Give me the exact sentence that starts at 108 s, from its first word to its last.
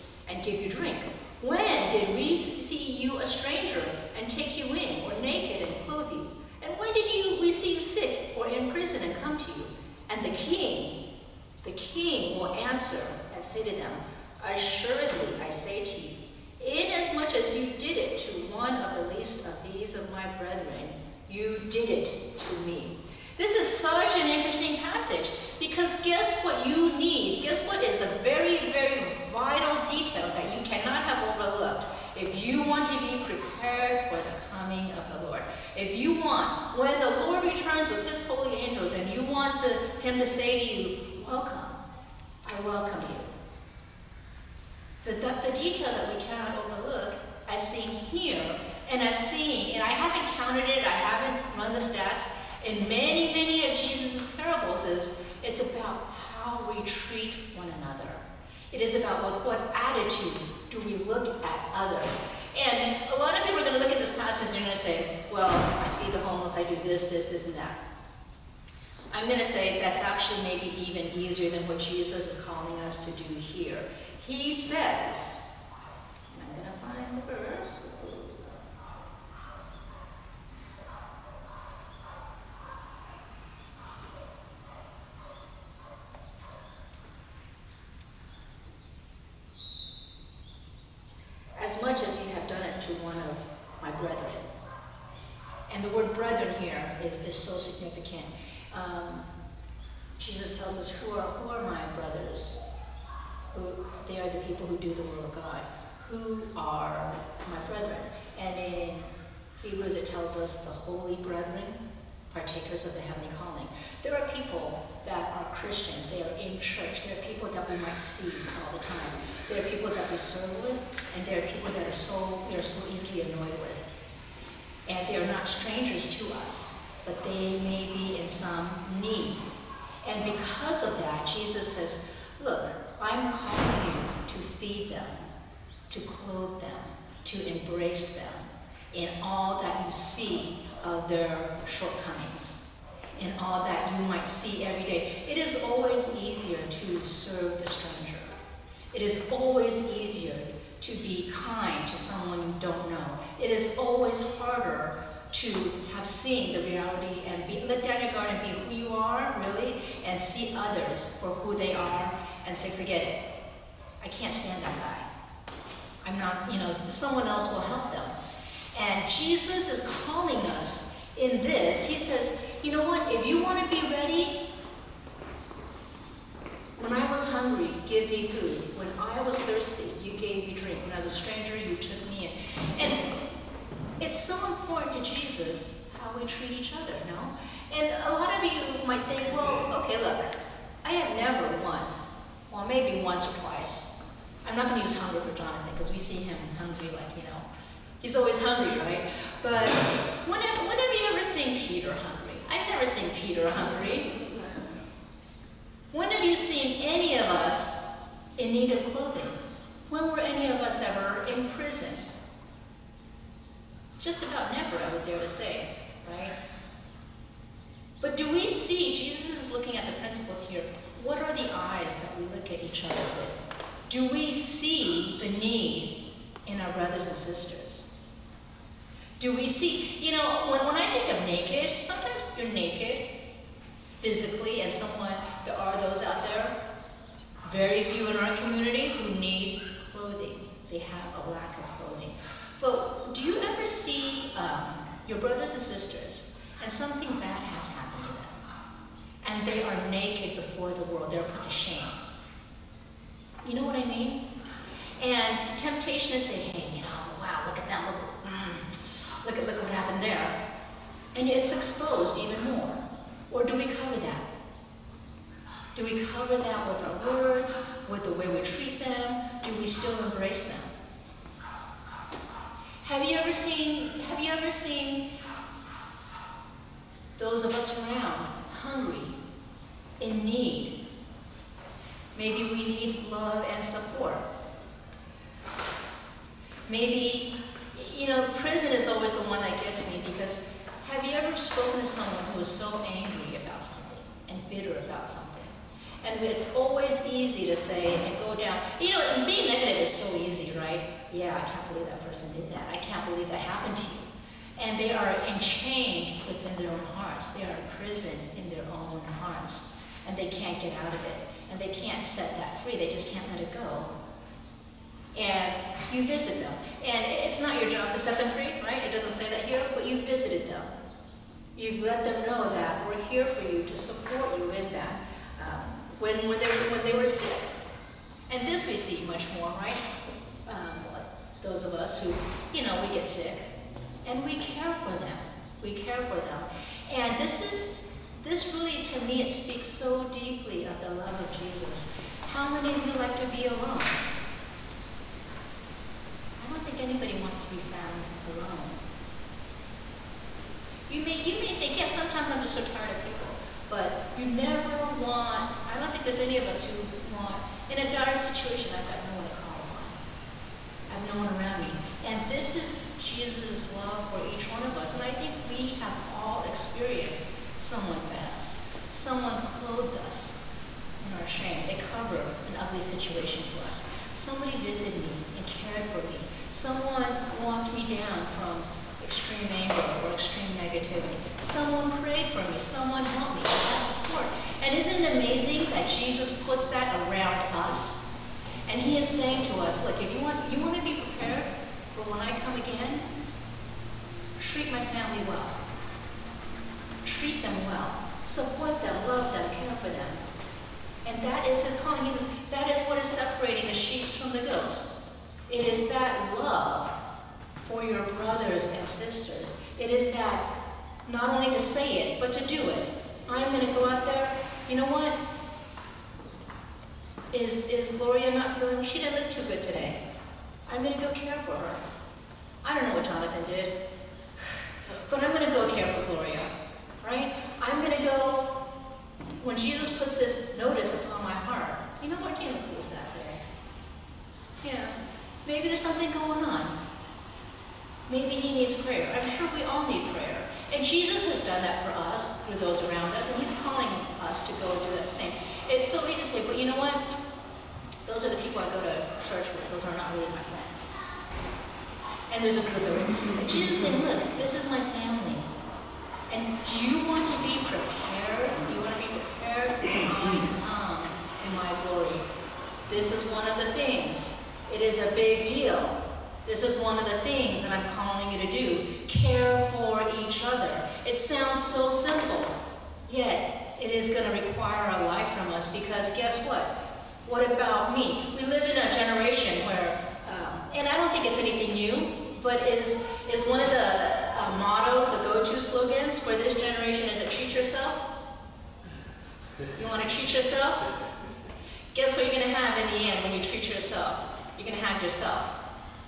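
And in Hebrews it tells us the holy brethren, partakers of the heavenly calling.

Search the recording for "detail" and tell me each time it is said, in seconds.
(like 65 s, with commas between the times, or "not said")
29 s, 45 s.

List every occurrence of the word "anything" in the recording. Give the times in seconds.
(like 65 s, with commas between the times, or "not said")
481 s.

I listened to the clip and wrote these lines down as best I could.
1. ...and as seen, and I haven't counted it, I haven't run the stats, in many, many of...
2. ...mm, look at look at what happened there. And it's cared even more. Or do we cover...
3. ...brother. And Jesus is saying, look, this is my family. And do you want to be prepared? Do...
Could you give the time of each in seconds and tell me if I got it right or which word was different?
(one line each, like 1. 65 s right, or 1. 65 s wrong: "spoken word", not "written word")
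1. 48 s right
2. 258 s wrong: "exposed", not "cared"
3. 452 s right.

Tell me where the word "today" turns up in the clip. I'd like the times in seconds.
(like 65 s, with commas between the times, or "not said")
419 s, 432 s.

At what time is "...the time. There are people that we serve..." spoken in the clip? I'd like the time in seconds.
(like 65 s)
118 s.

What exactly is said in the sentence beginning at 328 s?
And this we see much more, right?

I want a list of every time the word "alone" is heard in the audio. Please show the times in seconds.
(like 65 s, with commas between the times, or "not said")
343 s, 348 s.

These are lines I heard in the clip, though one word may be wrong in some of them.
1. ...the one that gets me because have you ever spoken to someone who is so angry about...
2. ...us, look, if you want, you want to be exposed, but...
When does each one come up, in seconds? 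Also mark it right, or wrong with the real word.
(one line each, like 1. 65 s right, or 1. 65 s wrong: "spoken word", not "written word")
1. 289 s right
2. 389 s wrong: "prepared", not "exposed".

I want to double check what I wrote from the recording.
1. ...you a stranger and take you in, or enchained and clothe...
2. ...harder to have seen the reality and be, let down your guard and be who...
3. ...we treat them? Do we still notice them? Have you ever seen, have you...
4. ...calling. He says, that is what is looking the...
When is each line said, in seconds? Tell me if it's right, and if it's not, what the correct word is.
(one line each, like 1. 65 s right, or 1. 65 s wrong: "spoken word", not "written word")
1. 2 s wrong: "naked", not "enchained"
2. 154 s right
3. 268 s wrong: "embrace", not "notice"
4. 401 s wrong: "separating", not "looking".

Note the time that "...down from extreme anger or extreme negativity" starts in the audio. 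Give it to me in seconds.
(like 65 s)
377 s.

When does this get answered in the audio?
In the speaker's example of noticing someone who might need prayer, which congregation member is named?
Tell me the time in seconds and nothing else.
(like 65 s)
432 s.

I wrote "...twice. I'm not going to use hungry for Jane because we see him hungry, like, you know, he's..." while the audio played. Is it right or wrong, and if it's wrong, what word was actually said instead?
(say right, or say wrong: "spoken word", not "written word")
wrong: "Jonathan", not "Jane".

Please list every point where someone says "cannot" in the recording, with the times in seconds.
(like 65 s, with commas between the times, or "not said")
30 s, 46 s.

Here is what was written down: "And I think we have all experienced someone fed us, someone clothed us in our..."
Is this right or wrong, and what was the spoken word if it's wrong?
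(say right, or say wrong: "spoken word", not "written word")
right.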